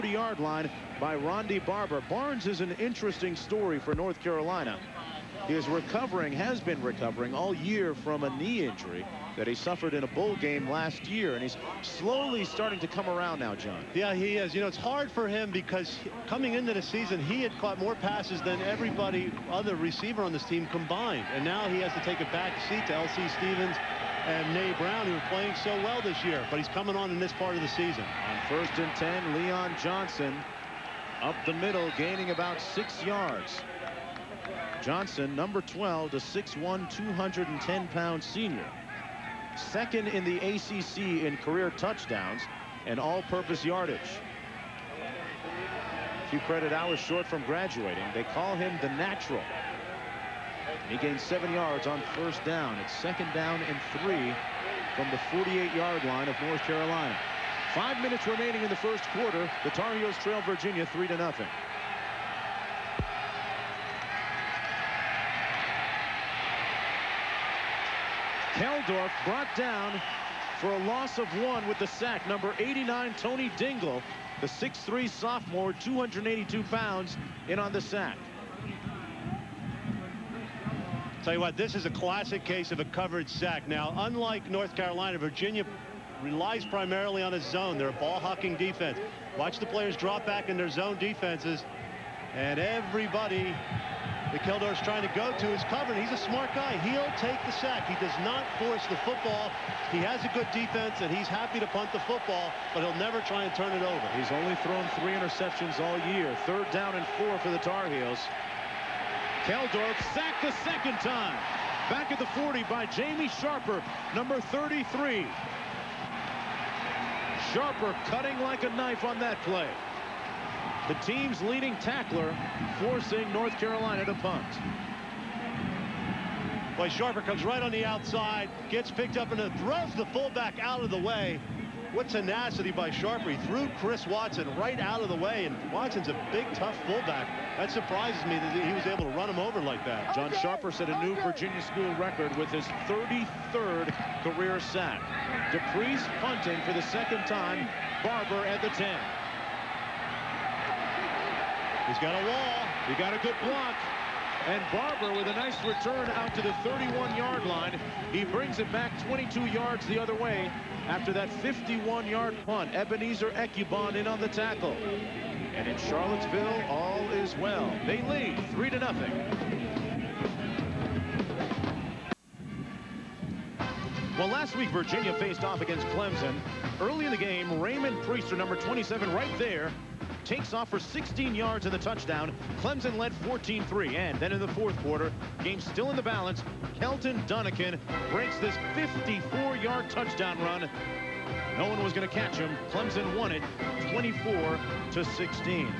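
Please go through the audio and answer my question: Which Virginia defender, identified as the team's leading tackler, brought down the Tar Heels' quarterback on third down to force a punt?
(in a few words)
Jamie Sharper.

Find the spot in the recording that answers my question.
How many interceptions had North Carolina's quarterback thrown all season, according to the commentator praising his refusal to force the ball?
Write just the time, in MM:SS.
01:45.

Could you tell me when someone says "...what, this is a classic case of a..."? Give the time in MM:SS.
01:21.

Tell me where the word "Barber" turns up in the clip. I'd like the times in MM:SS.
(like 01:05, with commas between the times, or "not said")
00:01, 02:28, 02:34.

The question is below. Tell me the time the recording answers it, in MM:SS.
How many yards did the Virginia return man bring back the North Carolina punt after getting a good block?
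02:39.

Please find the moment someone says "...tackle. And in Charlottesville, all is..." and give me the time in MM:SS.
02:44.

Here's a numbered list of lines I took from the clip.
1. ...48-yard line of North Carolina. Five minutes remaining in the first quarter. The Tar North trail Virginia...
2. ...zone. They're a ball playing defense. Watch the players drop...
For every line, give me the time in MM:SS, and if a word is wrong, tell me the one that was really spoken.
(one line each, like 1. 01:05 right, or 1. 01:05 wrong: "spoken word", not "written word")
1. 00:55 wrong: "Heels", not "North"
2. 01:27 wrong: "hucking", not "playing".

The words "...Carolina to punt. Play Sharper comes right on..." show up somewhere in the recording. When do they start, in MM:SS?
02:03.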